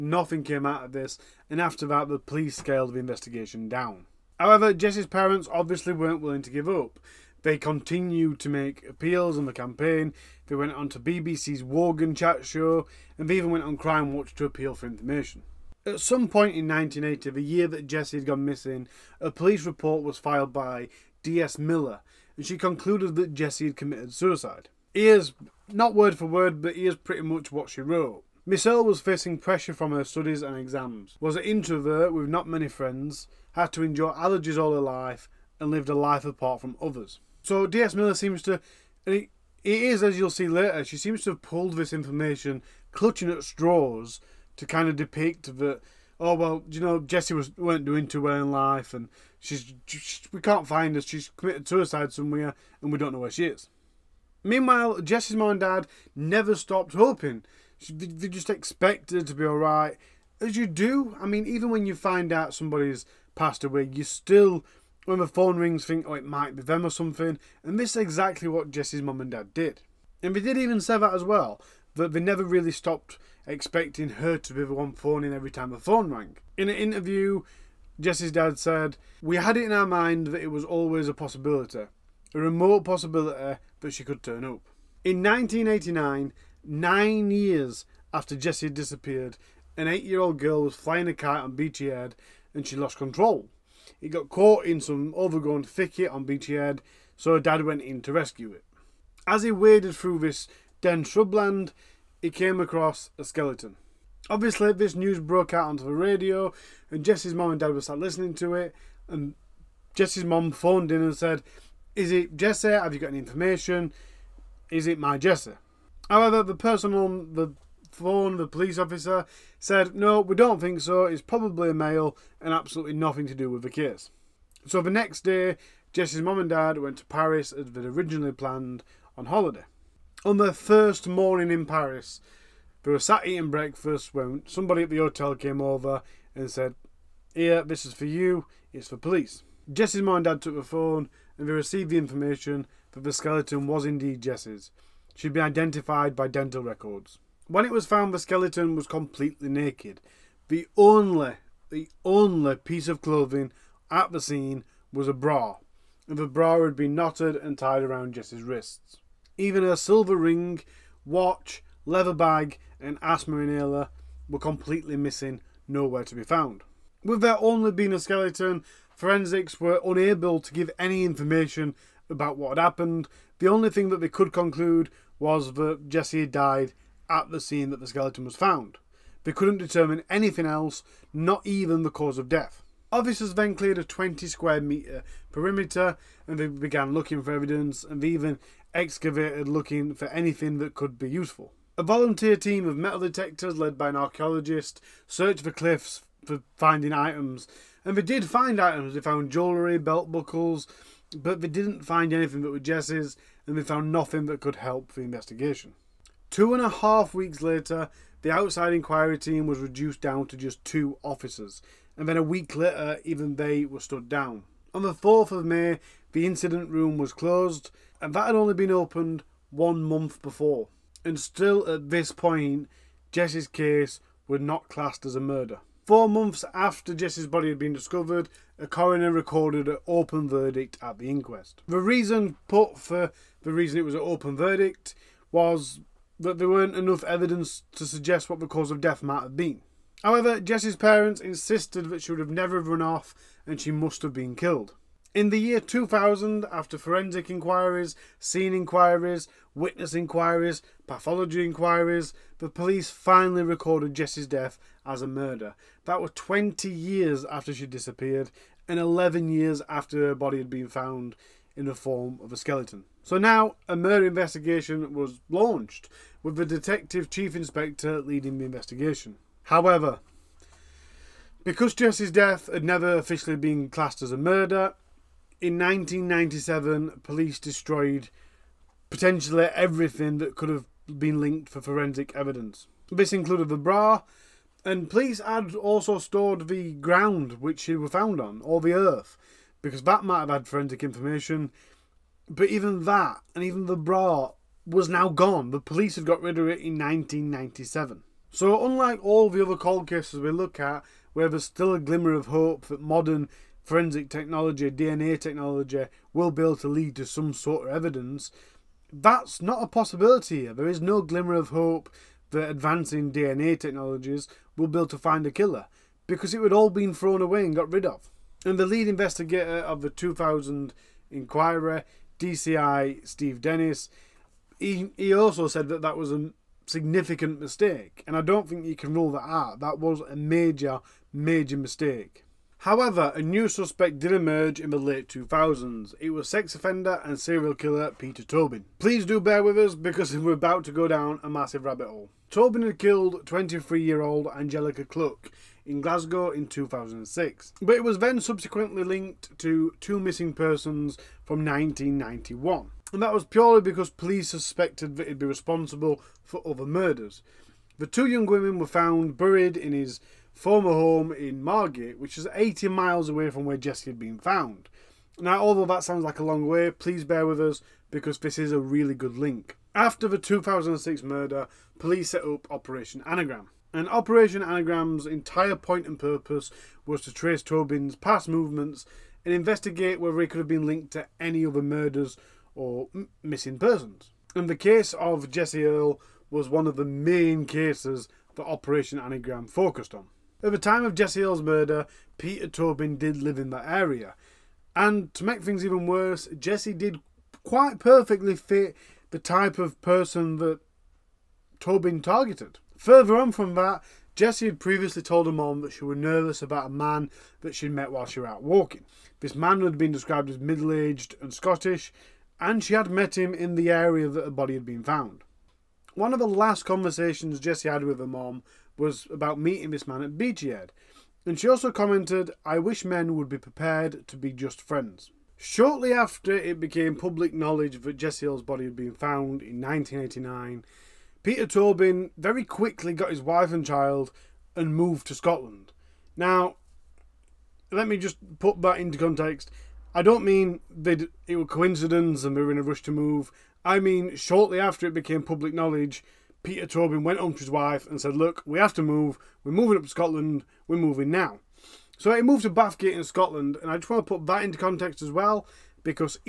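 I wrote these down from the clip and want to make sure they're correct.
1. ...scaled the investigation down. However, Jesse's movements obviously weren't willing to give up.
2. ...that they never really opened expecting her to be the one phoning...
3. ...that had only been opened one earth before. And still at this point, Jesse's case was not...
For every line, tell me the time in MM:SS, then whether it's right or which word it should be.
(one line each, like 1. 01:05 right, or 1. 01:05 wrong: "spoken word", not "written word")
1. 00:02 wrong: "parents", not "movements"
2. 01:11 wrong: "stopped", not "opened"
3. 03:38 wrong: "month", not "earth".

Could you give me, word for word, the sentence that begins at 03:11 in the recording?
A volunteer team of metal detectors led by an archaeologist searched the cliffs for finding items and they did find items.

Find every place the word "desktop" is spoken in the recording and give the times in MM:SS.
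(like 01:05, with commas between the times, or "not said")
not said.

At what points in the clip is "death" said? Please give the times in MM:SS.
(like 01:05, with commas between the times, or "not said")
03:02, 03:58, 04:14, 04:32.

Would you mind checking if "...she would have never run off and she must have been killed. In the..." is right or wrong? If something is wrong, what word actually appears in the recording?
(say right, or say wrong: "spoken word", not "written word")
right.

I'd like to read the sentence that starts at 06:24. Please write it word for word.
And the case of Jessie Earl was one of the main cases that Operation Anagram focused on.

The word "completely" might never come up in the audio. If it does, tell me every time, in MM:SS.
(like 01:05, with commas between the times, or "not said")
02:28, 02:44.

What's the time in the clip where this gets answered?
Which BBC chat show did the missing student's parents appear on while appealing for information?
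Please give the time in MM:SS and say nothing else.
00:11.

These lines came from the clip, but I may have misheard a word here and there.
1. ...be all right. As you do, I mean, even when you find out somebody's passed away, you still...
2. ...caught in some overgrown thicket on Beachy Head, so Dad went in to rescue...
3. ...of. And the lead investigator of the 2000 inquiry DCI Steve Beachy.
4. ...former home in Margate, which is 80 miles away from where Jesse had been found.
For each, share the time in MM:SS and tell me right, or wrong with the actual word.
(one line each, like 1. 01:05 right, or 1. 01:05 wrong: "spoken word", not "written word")
1. 00:59 right
2. 01:34 right
3. 05:17 wrong: "Dennis", not "Beachy"
4. 06:00 right.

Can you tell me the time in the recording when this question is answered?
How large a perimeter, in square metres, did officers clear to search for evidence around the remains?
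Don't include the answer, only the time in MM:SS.
03:03.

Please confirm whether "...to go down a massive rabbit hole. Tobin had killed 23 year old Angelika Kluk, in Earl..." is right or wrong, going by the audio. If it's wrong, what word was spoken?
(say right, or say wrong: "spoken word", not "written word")
wrong: "Glasgow", not "Earl".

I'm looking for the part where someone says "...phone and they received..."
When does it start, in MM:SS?
02:20.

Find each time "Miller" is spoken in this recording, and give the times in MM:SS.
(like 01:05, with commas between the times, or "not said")
00:21, 00:37.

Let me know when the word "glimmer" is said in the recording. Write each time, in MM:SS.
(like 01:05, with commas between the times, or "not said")
05:01, 05:11.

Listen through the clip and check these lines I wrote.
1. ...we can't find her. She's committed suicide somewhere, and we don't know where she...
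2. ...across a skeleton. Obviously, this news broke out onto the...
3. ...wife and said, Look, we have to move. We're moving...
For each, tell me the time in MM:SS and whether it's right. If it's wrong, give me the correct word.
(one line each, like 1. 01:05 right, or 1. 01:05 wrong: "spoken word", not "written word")
1. 00:50 right
2. 01:42 right
3. 07:27 right.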